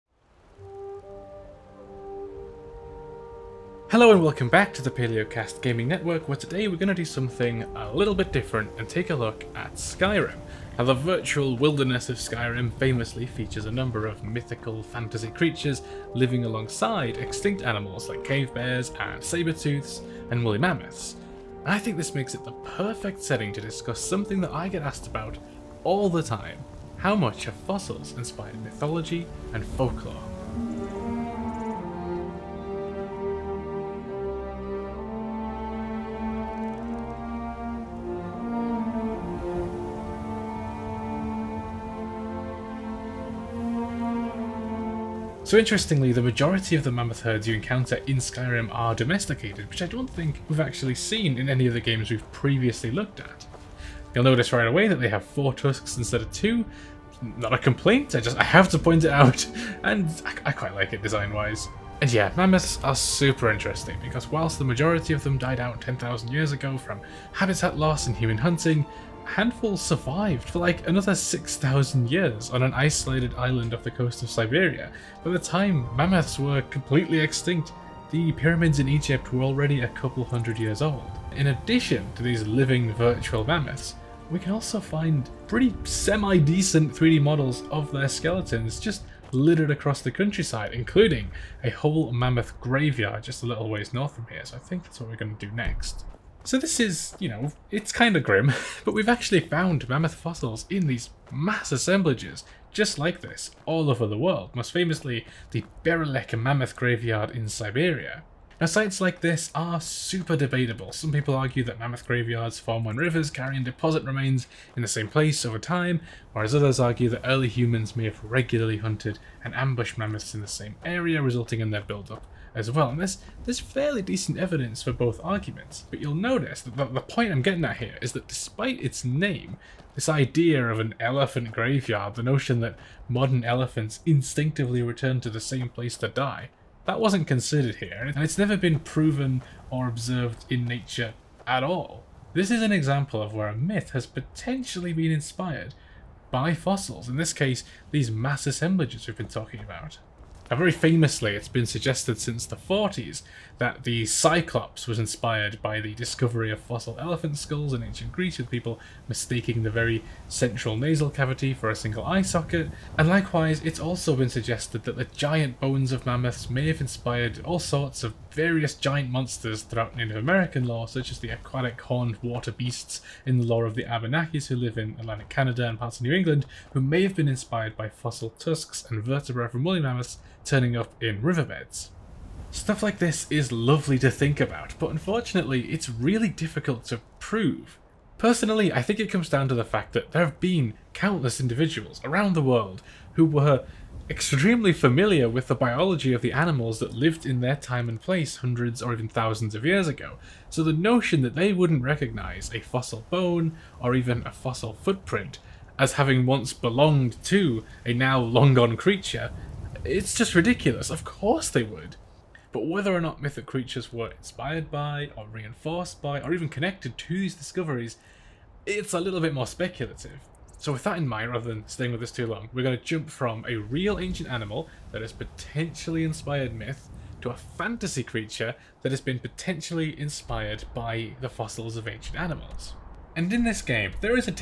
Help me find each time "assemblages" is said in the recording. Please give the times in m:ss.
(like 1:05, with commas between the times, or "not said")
1:41, 2:28.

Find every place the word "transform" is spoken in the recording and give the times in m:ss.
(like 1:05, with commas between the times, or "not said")
not said.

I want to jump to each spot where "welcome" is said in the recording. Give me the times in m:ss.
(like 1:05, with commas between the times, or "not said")
0:04.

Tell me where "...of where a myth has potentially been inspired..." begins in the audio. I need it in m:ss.
2:23.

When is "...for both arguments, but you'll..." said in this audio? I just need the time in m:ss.
2:04.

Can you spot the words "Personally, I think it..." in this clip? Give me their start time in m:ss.
3:08.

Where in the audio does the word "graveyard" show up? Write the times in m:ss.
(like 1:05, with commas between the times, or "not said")
1:32, 1:46, 1:52, 2:11.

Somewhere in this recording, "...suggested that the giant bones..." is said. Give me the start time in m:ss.
2:44.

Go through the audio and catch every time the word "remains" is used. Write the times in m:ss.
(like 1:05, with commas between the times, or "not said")
1:54.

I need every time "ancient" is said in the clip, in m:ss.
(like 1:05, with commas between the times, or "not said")
2:37, 3:43, 3:51.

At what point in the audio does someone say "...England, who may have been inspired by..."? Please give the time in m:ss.
2:56.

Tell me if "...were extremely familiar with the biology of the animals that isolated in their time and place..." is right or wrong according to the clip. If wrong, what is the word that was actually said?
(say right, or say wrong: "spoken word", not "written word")
wrong: "lived", not "isolated".